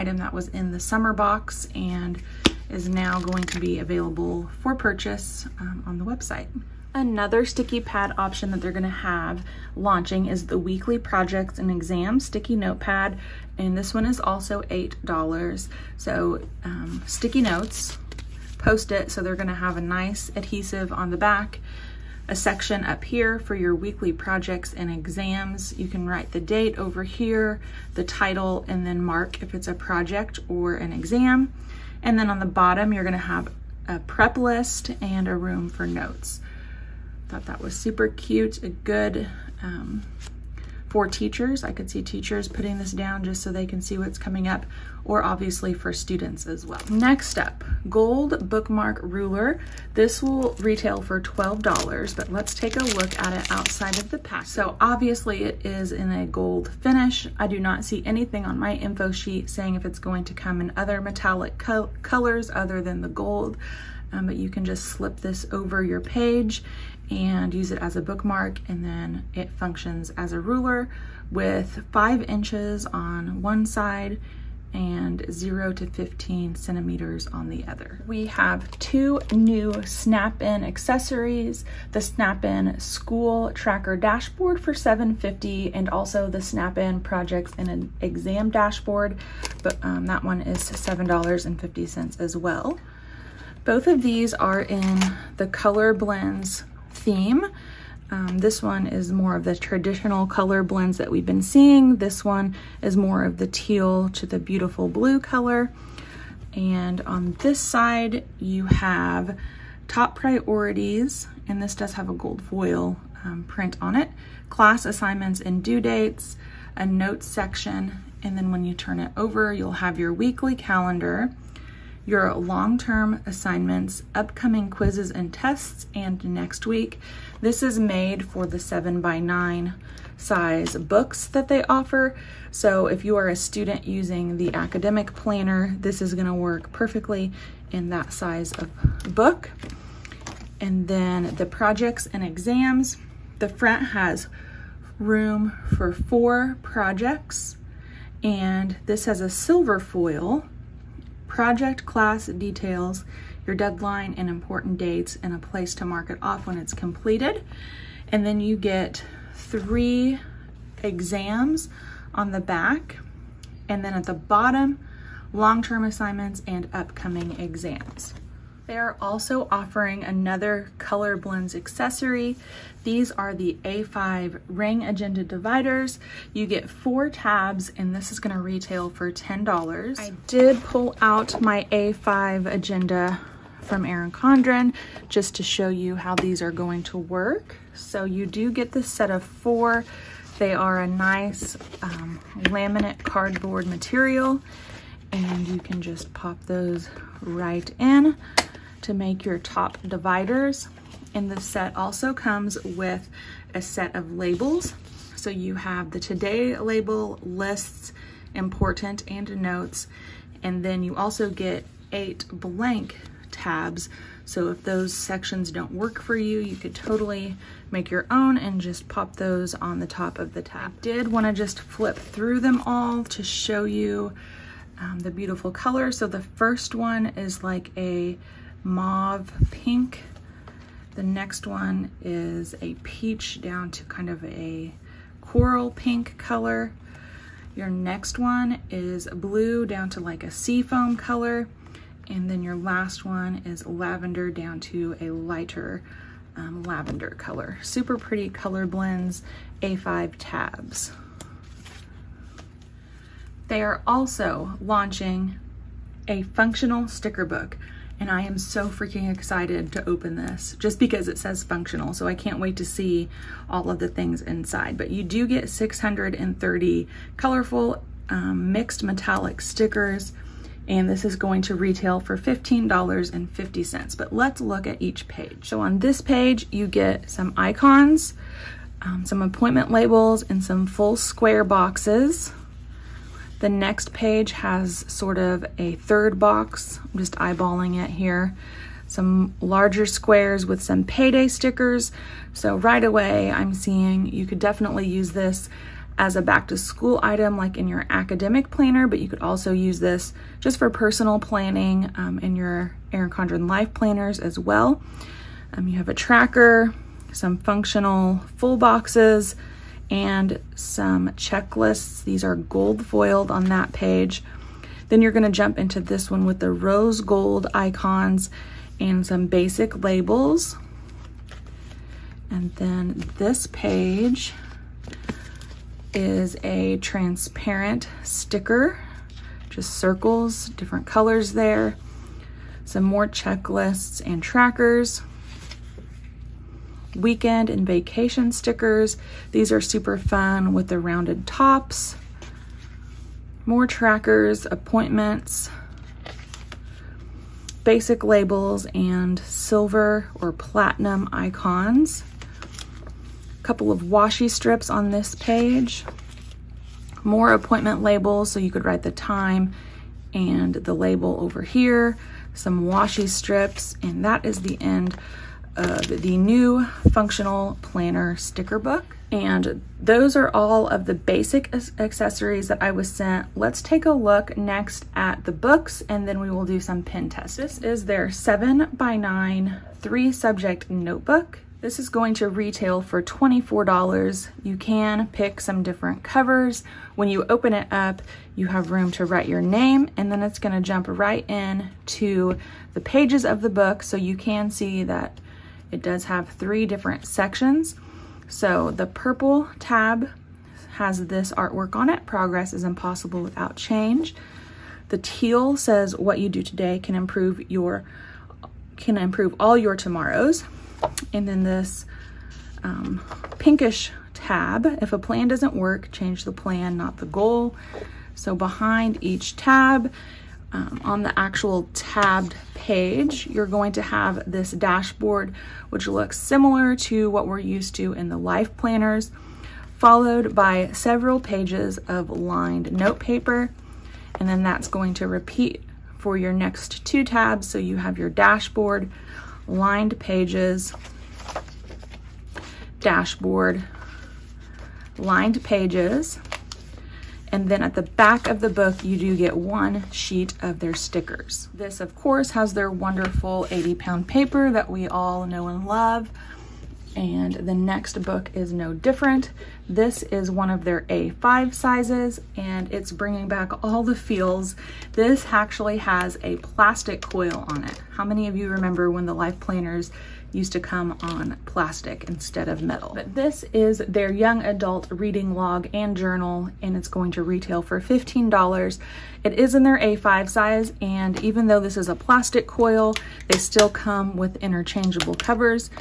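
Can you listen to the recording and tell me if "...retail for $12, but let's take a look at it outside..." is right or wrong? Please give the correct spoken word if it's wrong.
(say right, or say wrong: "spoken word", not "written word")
right.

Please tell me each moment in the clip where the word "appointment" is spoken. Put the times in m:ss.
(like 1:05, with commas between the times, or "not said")
4:39, 5:44, 5:57.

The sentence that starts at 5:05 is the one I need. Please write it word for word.
Um, you have a tracker, some functional full boxes, and some checklists.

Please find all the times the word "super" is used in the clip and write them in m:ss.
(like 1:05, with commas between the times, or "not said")
0:37, 4:07, 5:39.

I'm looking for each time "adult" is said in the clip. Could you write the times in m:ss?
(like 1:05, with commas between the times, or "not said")
7:54.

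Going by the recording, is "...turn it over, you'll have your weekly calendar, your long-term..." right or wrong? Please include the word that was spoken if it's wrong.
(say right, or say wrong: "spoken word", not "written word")
right.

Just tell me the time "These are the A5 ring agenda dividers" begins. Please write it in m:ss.
2:52.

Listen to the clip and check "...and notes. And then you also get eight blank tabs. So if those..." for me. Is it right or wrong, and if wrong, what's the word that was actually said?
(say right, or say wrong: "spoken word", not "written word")
right.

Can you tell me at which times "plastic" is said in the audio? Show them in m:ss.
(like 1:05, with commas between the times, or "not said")
7:46, 7:51, 8:01.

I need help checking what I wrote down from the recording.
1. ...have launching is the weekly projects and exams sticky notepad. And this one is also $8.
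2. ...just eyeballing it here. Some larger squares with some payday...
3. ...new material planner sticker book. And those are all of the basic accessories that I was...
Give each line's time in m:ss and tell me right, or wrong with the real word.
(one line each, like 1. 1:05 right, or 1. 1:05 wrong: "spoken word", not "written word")
1. 0:08 right
2. 4:46 right
3. 6:06 wrong: "functional", not "material".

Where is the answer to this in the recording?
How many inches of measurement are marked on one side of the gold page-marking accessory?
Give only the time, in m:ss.
1:11.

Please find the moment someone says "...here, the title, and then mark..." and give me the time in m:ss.
0:27.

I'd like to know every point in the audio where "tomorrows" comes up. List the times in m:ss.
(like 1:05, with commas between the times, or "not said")
6:49.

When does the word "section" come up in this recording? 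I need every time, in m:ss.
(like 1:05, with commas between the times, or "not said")
0:22, 1:57, 3:34, 6:37.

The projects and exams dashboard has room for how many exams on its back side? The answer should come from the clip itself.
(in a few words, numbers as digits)
3.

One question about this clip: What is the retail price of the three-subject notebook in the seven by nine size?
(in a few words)
$24.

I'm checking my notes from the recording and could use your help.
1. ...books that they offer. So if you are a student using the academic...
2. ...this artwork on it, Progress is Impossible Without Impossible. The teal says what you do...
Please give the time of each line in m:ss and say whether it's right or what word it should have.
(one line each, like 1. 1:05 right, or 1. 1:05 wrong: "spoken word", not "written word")
1. 2:10 right
2. 6:41 wrong: "Change", not "Impossible".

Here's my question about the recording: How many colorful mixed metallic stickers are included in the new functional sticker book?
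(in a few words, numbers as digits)
630.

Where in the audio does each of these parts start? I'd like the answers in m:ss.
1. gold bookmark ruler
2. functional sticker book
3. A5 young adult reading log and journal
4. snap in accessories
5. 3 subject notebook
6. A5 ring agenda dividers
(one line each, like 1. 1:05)
1. 0:47
2. 4:14
3. 7:40
4. 1:19
5. 6:18
6. 2:50.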